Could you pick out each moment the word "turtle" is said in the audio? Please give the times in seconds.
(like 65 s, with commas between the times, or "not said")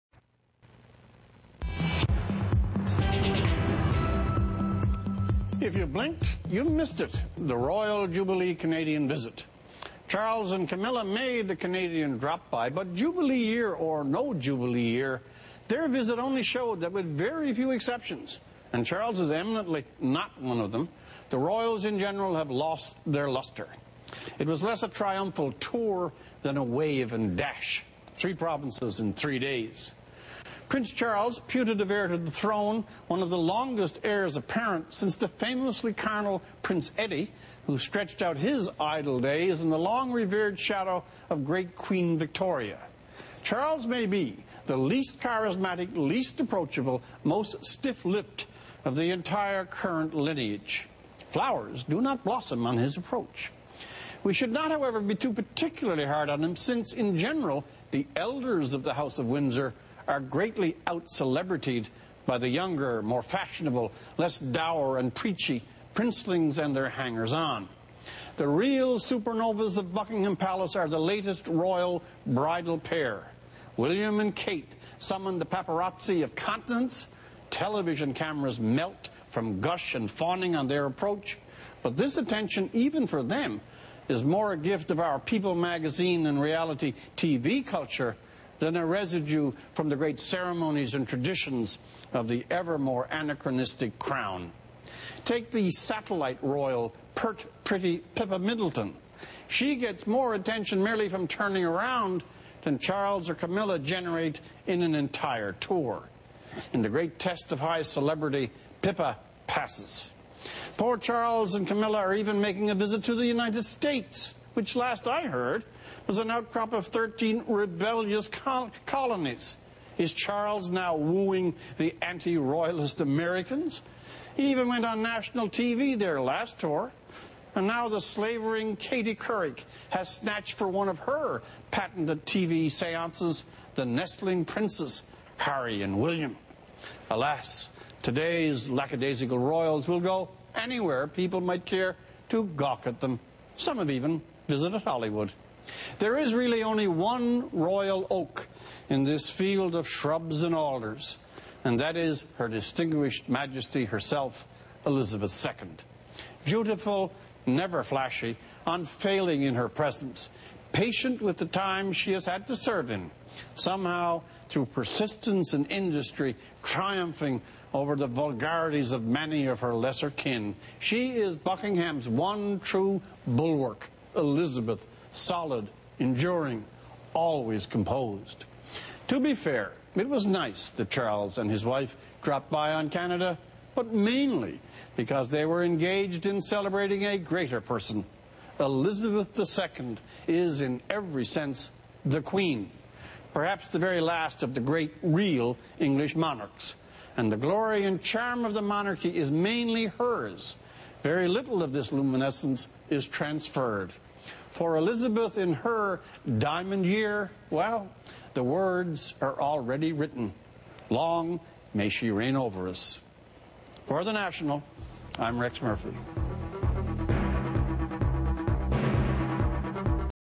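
not said.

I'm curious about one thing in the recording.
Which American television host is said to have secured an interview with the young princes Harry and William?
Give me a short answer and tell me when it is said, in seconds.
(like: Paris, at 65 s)
Katie Couric, at 128 s.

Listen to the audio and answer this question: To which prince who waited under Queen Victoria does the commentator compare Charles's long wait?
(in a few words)
Prince Eddie.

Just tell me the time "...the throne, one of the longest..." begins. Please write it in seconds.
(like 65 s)
32 s.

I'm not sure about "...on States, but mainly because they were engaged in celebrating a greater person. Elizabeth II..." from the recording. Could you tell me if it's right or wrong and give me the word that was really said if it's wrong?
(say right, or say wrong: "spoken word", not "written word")
wrong: "Canada", not "States".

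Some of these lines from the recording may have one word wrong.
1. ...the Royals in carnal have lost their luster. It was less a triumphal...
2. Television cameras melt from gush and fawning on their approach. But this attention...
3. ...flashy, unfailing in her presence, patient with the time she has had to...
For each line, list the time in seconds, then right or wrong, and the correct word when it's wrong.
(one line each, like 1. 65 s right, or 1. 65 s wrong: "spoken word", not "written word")
1. 21 s wrong: "general", not "carnal"
2. 77 s right
3. 157 s right.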